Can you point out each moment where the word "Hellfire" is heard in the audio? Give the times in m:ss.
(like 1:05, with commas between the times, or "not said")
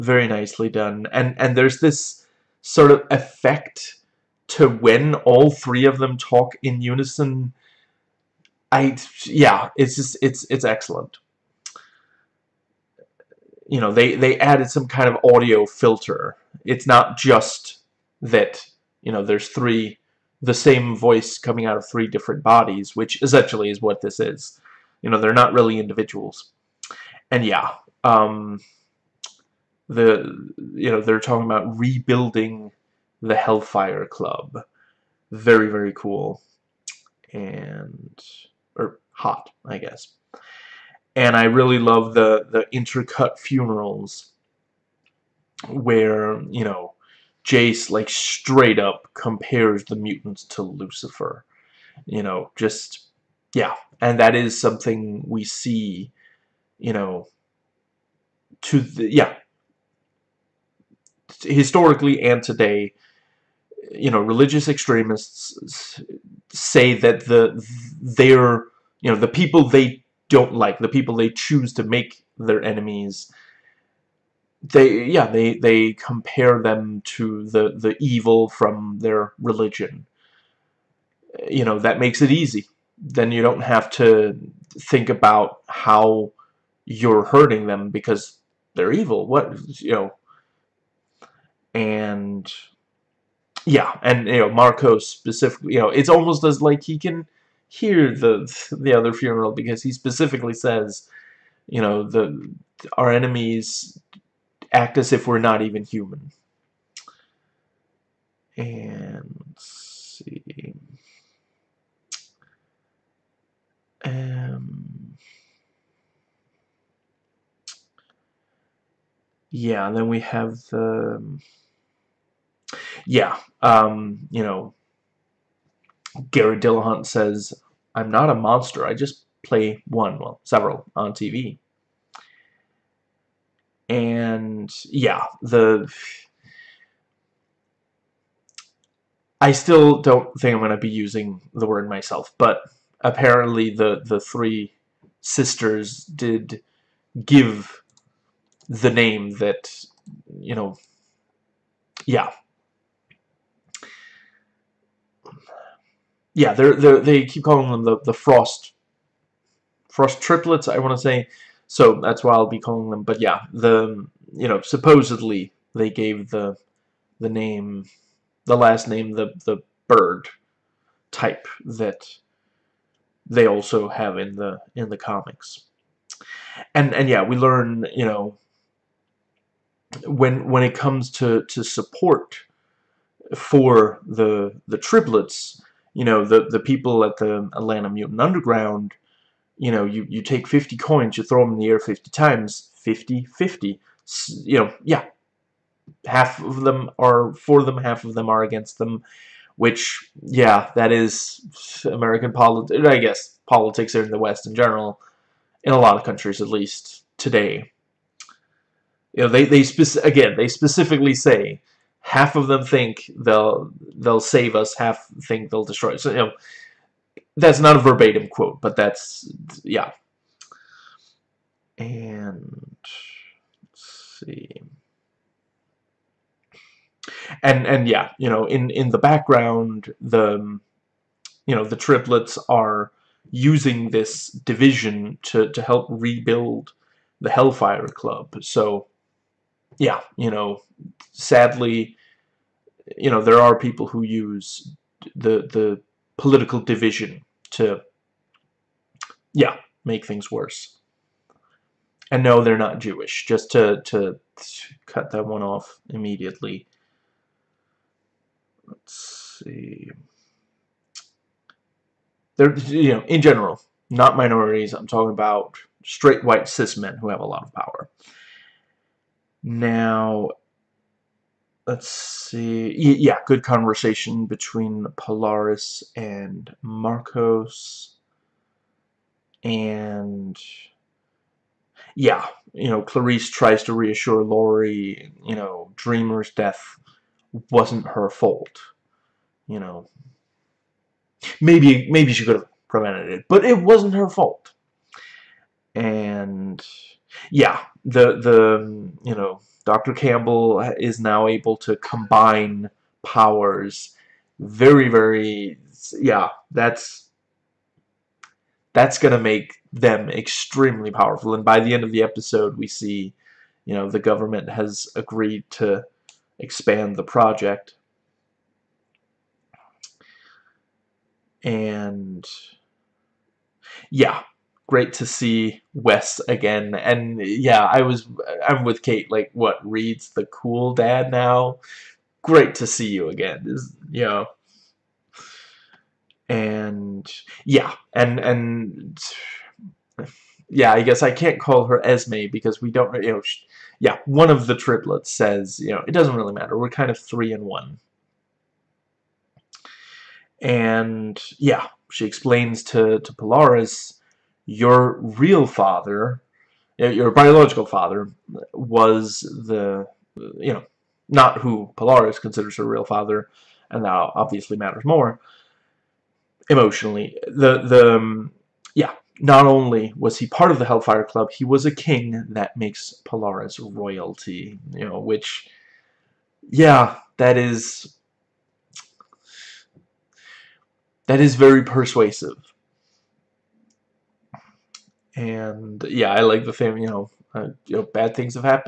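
0:33, 3:57, 6:10.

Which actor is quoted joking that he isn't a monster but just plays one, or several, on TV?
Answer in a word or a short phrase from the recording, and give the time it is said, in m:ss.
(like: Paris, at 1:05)
Garret Dillahunt, at 2:06.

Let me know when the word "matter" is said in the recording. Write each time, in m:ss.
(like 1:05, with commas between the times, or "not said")
5:46, 6:04.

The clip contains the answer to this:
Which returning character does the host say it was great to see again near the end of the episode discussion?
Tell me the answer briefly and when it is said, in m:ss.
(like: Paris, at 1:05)
Wes, at 5:25.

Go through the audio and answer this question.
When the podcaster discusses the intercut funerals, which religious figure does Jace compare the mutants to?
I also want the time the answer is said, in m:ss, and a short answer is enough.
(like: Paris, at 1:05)
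Lucifer, at 0:50.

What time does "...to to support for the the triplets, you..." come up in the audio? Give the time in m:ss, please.
3:01.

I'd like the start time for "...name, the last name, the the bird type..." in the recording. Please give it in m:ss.
2:47.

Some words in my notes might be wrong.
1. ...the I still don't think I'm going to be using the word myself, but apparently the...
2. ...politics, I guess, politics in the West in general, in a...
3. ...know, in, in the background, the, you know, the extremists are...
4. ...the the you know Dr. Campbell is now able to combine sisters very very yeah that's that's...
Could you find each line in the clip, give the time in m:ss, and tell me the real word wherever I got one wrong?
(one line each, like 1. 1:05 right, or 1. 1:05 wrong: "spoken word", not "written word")
1. 2:15 right
2. 3:22 right
3. 3:48 wrong: "triplets", not "extremists"
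4. 4:57 wrong: "powers", not "sisters".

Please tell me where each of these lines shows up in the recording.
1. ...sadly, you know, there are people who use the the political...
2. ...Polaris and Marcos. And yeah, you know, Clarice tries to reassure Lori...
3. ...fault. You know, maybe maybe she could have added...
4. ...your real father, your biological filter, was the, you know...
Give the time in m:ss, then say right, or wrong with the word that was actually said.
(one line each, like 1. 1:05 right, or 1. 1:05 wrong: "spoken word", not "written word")
1. 4:01 right
2. 4:34 right
3. 4:48 wrong: "prevented", not "added"
4. 5:54 wrong: "father", not "filter".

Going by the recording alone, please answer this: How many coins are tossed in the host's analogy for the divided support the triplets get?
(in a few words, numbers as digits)
50.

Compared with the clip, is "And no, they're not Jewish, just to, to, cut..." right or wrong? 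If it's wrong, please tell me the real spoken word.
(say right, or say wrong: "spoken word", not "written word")
right.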